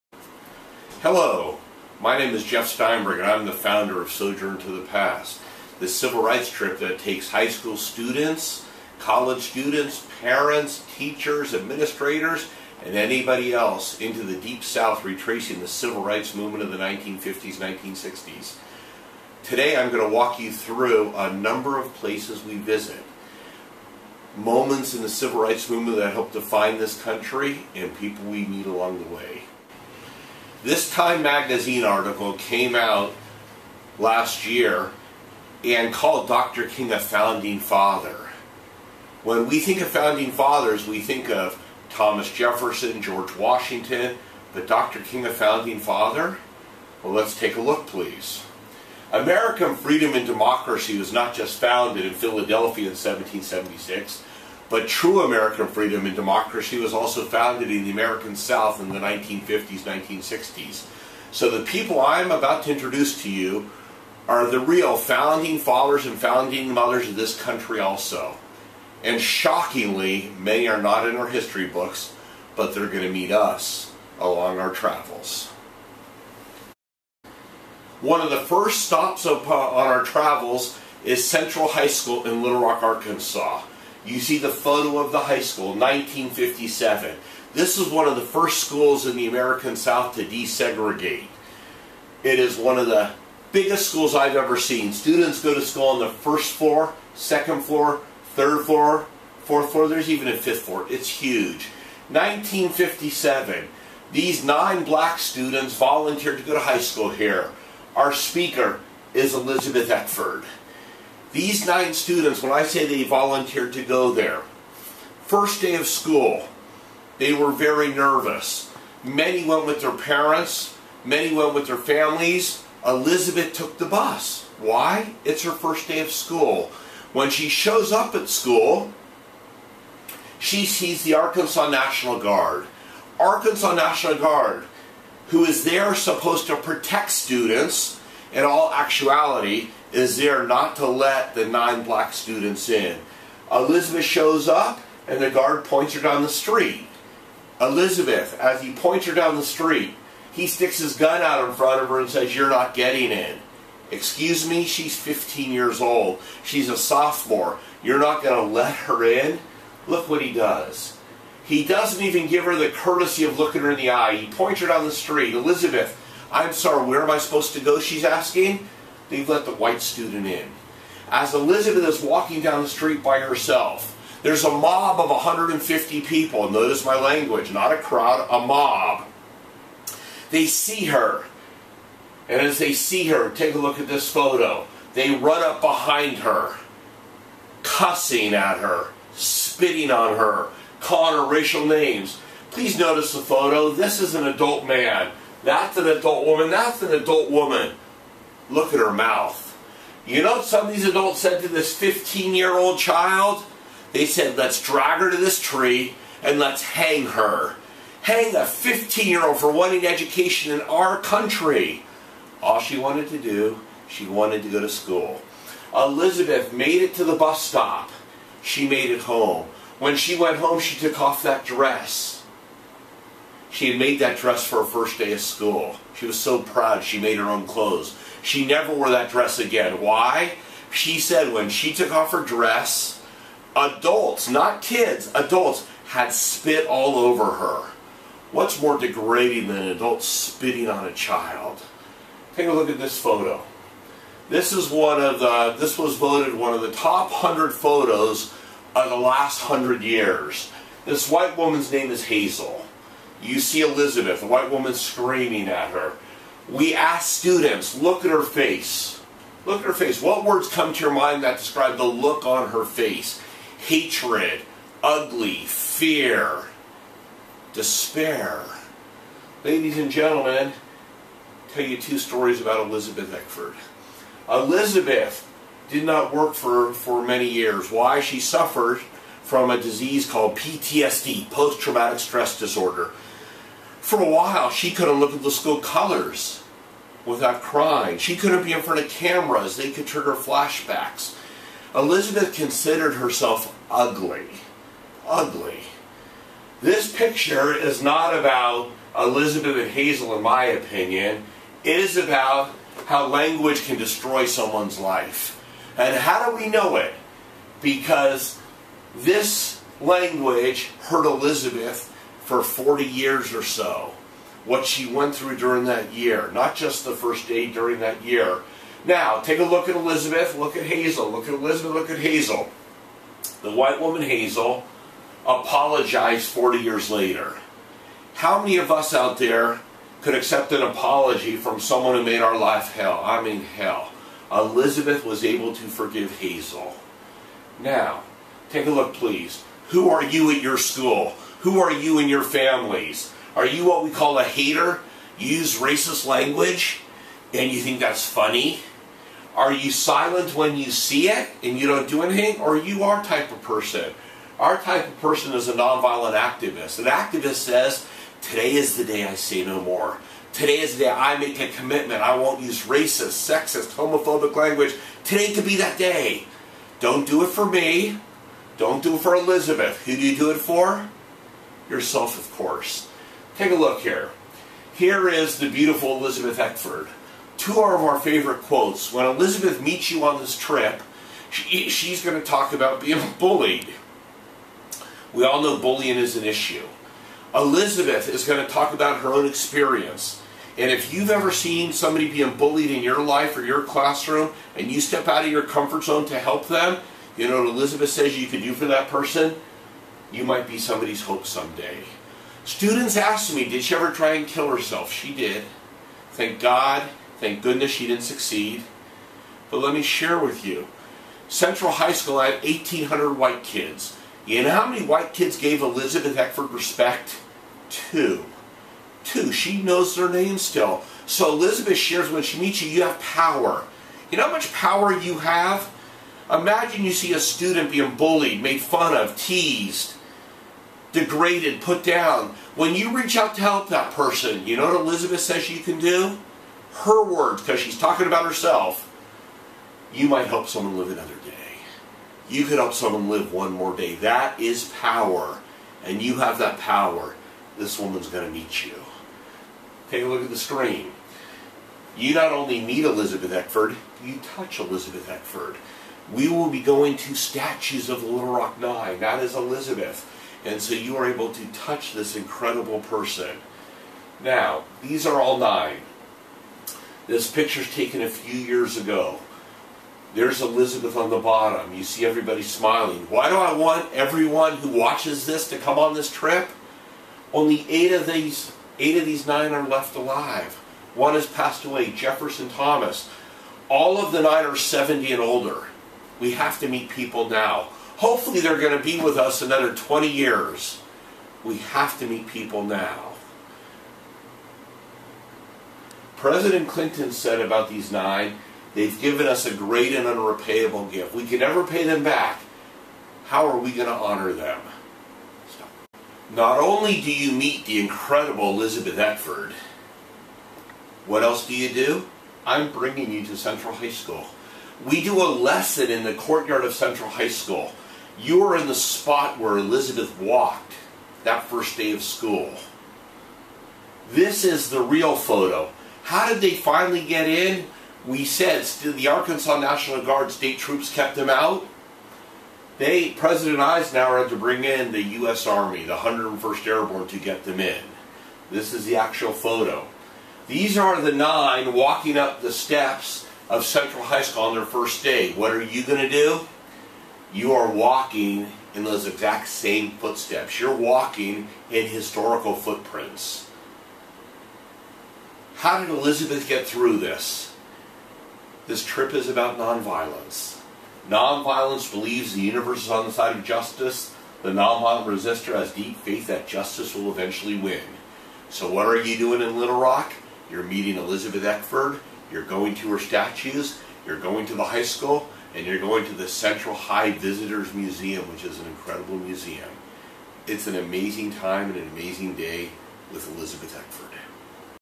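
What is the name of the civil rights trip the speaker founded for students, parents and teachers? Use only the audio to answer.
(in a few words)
Sojourn to the Past.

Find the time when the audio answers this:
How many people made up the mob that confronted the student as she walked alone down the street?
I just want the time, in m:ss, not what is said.
2:55.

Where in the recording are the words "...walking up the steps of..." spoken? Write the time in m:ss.
9:01.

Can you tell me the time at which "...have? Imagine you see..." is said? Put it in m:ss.
7:05.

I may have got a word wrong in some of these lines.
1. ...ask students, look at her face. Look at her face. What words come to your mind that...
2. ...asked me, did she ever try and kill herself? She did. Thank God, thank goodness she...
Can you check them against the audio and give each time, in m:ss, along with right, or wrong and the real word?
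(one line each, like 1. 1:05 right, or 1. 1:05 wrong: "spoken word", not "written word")
1. 4:16 right
2. 6:42 right.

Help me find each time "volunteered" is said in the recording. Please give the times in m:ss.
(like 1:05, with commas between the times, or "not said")
1:45, 1:53.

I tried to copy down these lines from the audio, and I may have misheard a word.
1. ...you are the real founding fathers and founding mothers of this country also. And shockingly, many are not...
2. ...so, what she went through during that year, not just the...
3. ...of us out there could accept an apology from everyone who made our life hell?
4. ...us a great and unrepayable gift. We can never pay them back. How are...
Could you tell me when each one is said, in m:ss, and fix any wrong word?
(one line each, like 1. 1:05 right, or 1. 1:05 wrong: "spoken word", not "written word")
1. 1:03 right
2. 5:13 right
3. 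5:28 wrong: "someone", not "everyone"
4. 8:19 right.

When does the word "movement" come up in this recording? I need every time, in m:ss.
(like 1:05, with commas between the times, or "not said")
0:16, 0:25.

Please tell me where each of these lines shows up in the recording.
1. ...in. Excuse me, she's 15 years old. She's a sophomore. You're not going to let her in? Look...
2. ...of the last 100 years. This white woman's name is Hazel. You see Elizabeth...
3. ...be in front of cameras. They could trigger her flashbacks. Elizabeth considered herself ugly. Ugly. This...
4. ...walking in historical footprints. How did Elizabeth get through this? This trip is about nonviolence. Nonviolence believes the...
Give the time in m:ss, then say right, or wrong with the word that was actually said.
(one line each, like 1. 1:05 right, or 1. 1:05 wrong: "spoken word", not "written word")
1. 2:33 right
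2. 4:08 right
3. 4:48 right
4. 9:10 right.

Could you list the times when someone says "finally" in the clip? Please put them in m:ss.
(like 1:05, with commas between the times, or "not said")
8:46.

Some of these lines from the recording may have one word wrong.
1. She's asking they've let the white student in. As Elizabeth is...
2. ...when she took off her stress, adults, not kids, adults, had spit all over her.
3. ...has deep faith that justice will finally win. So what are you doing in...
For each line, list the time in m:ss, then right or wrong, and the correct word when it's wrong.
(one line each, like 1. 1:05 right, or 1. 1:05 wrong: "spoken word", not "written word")
1. 2:47 right
2. 3:51 wrong: "dress", not "stress"
3. 9:25 wrong: "eventually", not "finally".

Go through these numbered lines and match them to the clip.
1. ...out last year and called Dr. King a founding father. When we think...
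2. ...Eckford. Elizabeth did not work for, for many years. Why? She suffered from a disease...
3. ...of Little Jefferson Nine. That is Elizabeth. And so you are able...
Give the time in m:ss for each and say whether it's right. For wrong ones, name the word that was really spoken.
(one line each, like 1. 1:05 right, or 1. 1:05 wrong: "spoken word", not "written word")
1. 0:32 right
2. 4:33 right
3. 7:37 wrong: "Rock", not "Jefferson".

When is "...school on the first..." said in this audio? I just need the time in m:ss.
1:35.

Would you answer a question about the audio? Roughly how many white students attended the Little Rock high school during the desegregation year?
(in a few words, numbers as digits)
1,800.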